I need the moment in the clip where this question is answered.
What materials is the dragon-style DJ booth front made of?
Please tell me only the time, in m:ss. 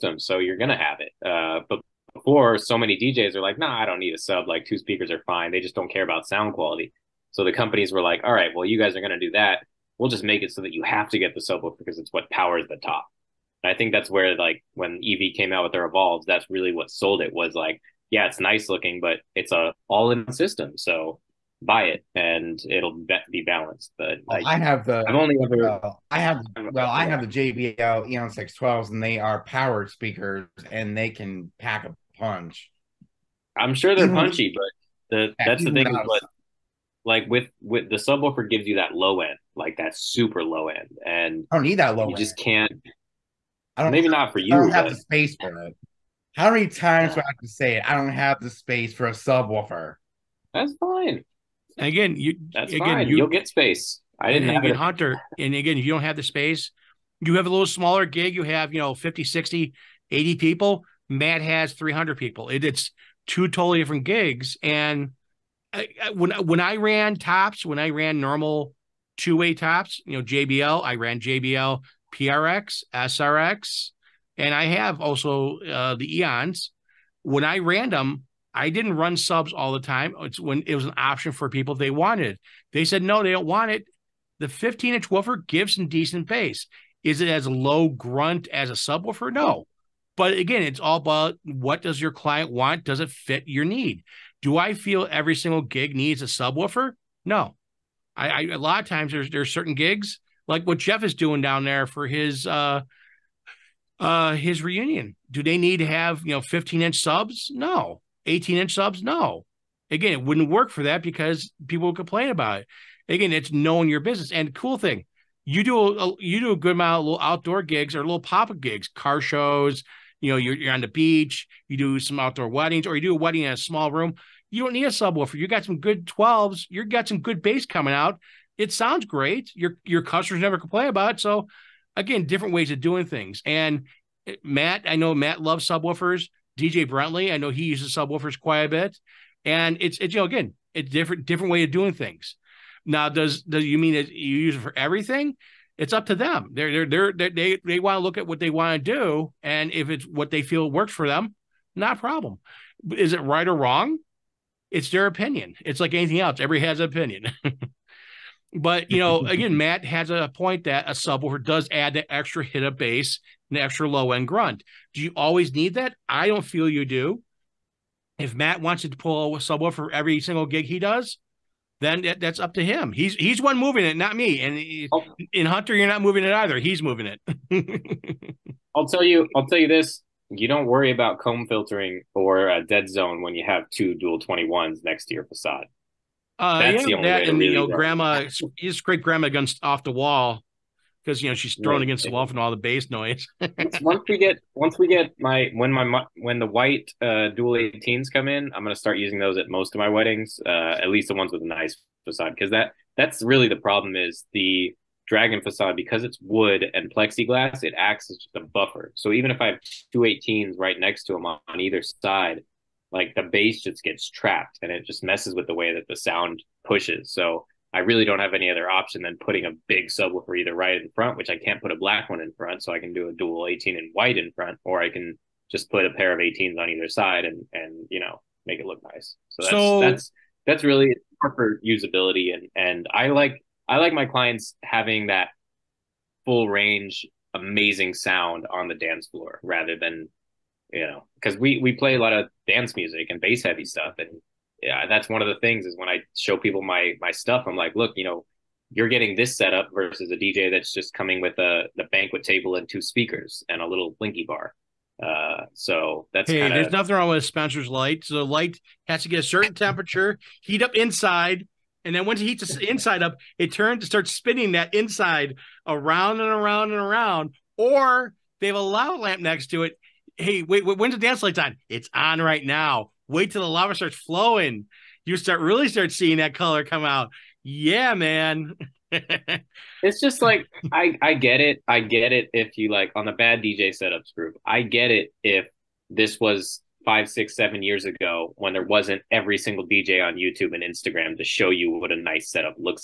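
3:26.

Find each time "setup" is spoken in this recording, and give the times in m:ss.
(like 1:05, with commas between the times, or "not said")
4:09, 4:43, 4:52.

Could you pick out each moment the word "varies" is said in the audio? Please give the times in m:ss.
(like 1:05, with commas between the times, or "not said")
not said.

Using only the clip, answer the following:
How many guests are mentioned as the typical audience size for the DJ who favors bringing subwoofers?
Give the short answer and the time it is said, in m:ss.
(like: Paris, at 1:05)
300, at 1:01.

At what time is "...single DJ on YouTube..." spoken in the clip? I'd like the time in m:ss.
4:49.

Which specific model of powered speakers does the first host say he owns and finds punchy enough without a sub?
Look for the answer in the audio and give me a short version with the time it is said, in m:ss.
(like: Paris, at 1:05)
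JBL Eon 612, at 0:27.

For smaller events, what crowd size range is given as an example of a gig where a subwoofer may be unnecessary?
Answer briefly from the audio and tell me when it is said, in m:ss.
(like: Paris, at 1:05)
50 to 80 people, at 0:58.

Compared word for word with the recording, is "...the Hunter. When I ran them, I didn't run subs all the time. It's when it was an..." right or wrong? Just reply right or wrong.
wrong.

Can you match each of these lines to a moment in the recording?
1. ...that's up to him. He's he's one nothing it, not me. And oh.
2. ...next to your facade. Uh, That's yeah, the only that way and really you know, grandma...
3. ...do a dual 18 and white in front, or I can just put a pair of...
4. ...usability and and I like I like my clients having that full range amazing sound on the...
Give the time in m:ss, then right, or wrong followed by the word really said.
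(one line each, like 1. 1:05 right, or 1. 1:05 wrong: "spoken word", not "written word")
1. 2:52 wrong: "moving", not "nothing"
2. 3:04 right
3. 3:42 right
4. 3:51 right.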